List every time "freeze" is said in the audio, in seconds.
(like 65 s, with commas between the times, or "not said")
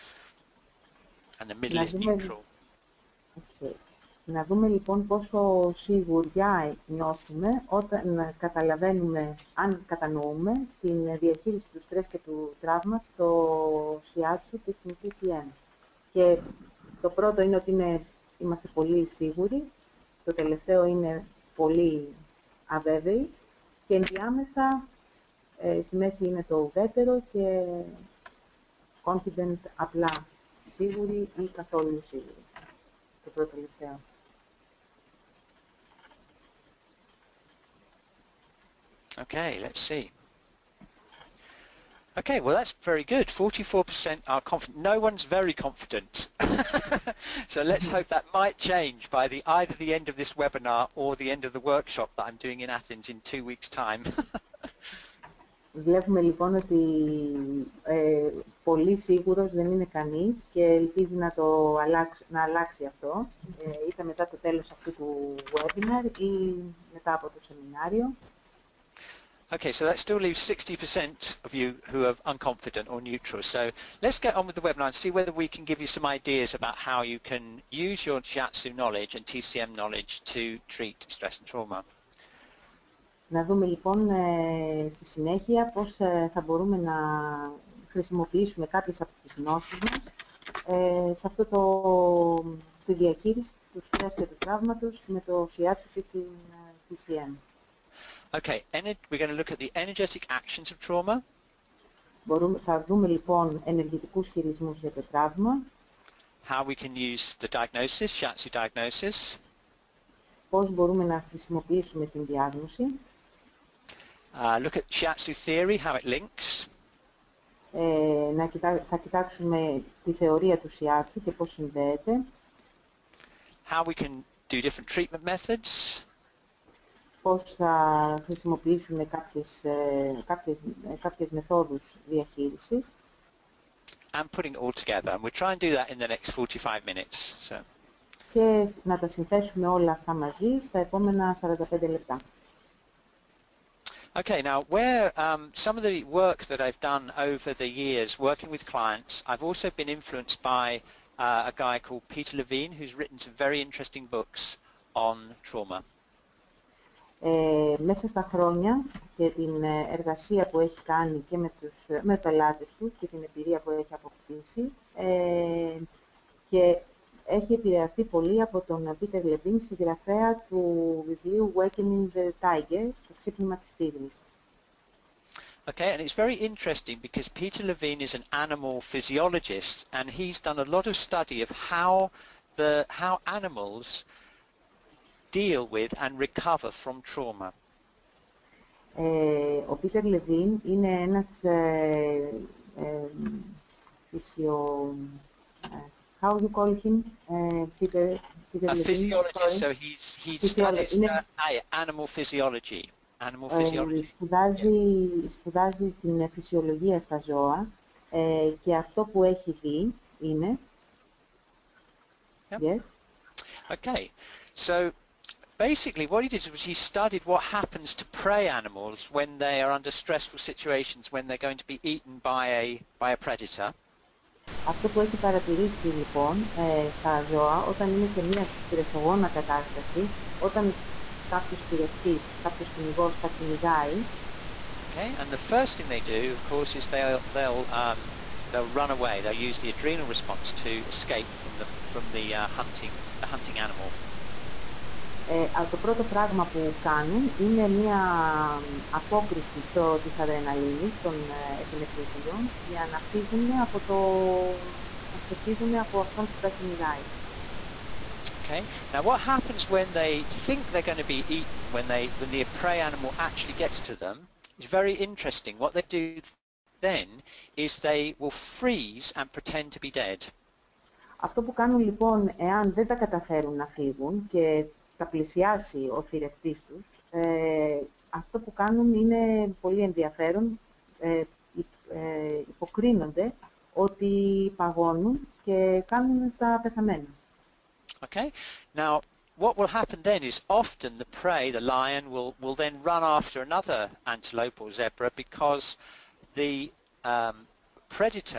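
268 s.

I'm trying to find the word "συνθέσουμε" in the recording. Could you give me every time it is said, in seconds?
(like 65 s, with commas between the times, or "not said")
139 s.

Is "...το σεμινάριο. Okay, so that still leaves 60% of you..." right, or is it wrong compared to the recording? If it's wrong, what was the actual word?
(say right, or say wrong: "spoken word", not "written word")
right.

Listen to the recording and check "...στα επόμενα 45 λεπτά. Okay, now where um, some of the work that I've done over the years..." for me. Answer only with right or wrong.
right.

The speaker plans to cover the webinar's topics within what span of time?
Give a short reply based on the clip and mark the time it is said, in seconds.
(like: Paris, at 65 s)
45 minutes, at 136 s.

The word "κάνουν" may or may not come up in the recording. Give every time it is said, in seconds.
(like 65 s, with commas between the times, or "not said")
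246 s, 271 s, 278 s, 285 s.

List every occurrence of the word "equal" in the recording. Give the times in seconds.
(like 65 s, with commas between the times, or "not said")
not said.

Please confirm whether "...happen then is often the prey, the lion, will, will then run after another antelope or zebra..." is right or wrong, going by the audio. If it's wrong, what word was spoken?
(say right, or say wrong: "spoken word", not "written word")
right.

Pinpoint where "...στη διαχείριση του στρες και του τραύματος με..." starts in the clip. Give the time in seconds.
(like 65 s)
92 s.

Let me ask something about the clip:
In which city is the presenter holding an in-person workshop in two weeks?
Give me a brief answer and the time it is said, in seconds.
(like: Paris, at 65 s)
Athens, at 52 s.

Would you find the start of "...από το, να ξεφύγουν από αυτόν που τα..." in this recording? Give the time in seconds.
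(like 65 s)
253 s.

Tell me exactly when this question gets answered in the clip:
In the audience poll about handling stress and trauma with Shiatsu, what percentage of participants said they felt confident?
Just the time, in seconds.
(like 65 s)
43 s.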